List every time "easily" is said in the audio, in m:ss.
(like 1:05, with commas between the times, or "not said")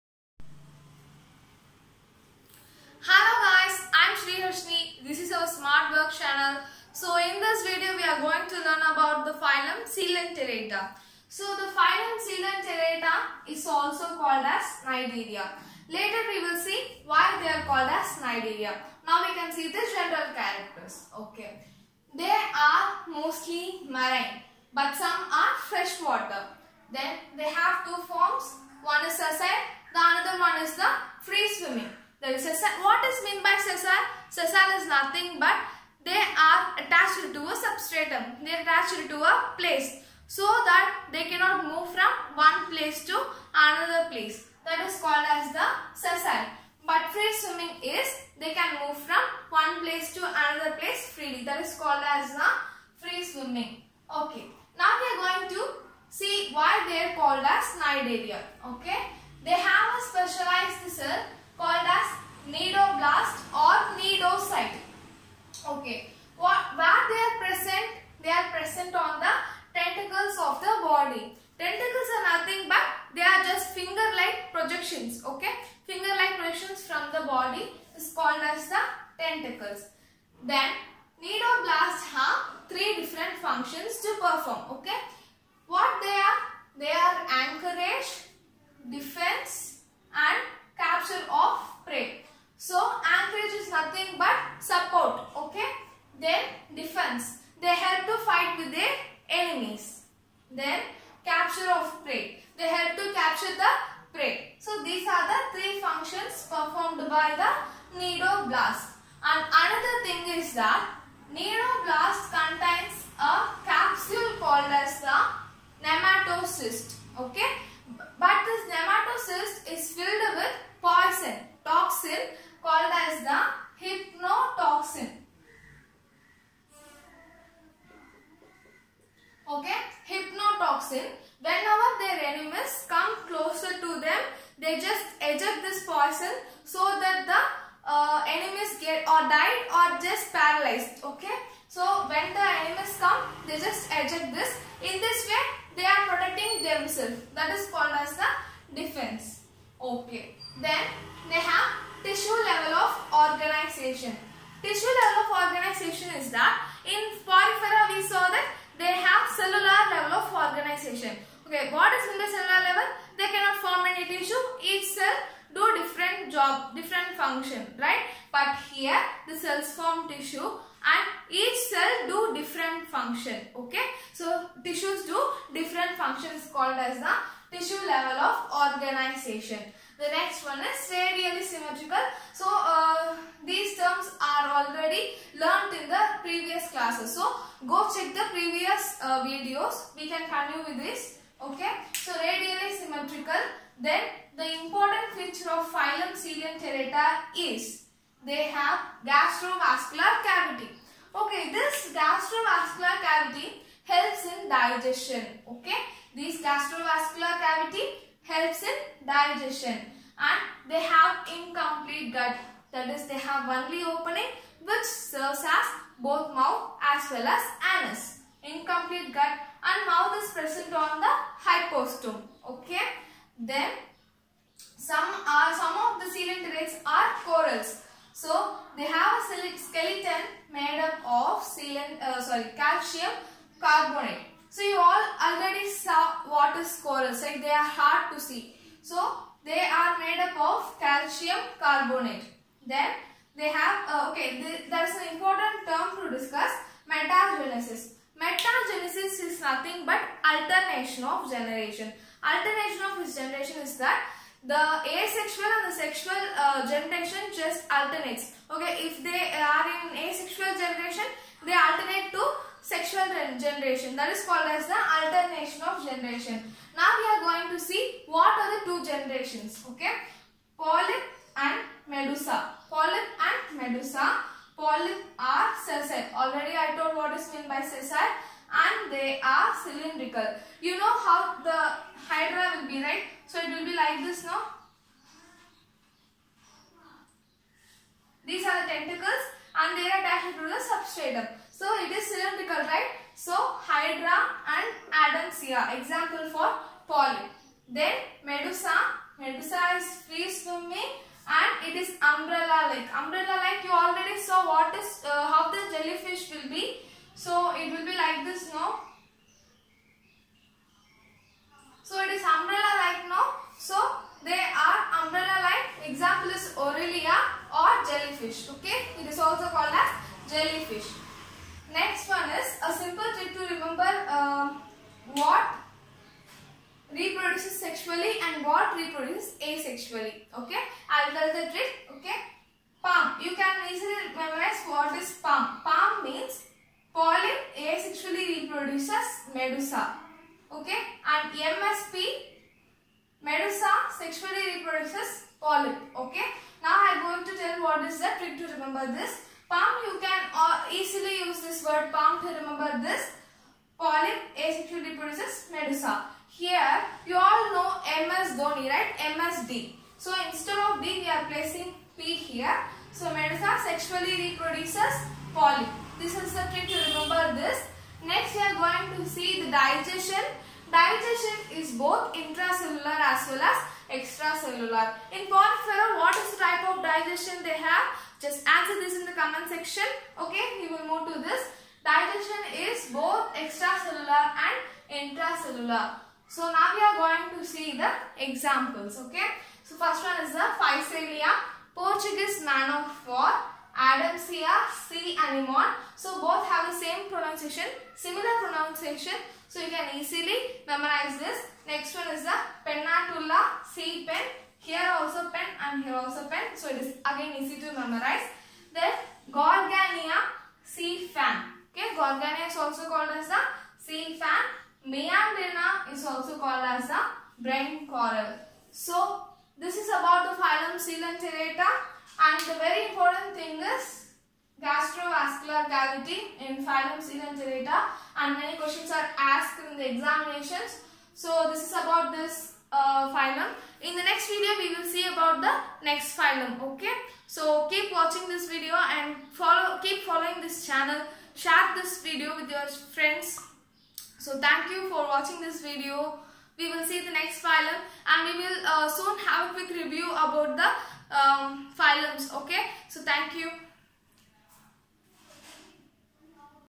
5:33, 5:50, 6:39.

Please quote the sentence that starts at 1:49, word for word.
And another thing is that cnidoblast contains a capsule called as the nematocyst.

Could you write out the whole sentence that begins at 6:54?
Meandrina is also called as the brain coral.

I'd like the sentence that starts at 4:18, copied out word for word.
Okay, if they are in asexual generation, they alternate to sexual generation.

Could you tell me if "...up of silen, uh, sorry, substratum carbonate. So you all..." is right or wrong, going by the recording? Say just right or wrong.
wrong.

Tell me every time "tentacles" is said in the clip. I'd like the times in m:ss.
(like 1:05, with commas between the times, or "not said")
1:09, 4:48.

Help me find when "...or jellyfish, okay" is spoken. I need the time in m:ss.
5:17.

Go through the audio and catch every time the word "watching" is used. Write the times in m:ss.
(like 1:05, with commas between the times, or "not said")
7:17, 7:25.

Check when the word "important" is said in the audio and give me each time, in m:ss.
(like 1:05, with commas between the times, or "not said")
3:14, 4:05, 7:02.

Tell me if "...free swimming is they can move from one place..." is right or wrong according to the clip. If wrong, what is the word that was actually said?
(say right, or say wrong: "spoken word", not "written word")
right.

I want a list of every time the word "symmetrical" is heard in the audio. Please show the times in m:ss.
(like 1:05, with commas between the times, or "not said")
3:01, 3:12.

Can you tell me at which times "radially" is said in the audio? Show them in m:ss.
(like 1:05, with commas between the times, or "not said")
3:00, 3:12.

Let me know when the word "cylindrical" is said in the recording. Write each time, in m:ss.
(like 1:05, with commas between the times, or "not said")
4:39, 4:52.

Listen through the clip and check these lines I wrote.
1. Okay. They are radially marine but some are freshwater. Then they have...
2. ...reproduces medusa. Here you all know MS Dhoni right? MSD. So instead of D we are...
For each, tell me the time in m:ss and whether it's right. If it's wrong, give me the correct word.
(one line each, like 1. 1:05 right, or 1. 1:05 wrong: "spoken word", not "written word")
1. 0:21 wrong: "mostly", not "radially"
2. 5:54 right.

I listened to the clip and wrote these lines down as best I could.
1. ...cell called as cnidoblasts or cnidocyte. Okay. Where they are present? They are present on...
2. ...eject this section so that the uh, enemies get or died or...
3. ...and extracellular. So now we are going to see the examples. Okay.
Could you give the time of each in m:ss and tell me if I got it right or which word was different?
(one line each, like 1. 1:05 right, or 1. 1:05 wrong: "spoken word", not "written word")
1. 1:00 right
2. 2:15 wrong: "poison", not "section"
3. 6:24 wrong: "intracellular", not "extracellular".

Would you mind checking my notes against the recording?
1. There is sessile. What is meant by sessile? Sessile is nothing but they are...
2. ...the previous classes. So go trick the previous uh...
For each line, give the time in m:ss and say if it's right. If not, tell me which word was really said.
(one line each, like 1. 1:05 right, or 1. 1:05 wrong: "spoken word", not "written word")
1. 0:32 right
2. 3:05 wrong: "check", not "trick".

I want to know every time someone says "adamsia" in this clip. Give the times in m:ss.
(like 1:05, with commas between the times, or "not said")
4:54, 6:33.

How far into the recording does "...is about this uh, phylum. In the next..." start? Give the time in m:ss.
7:11.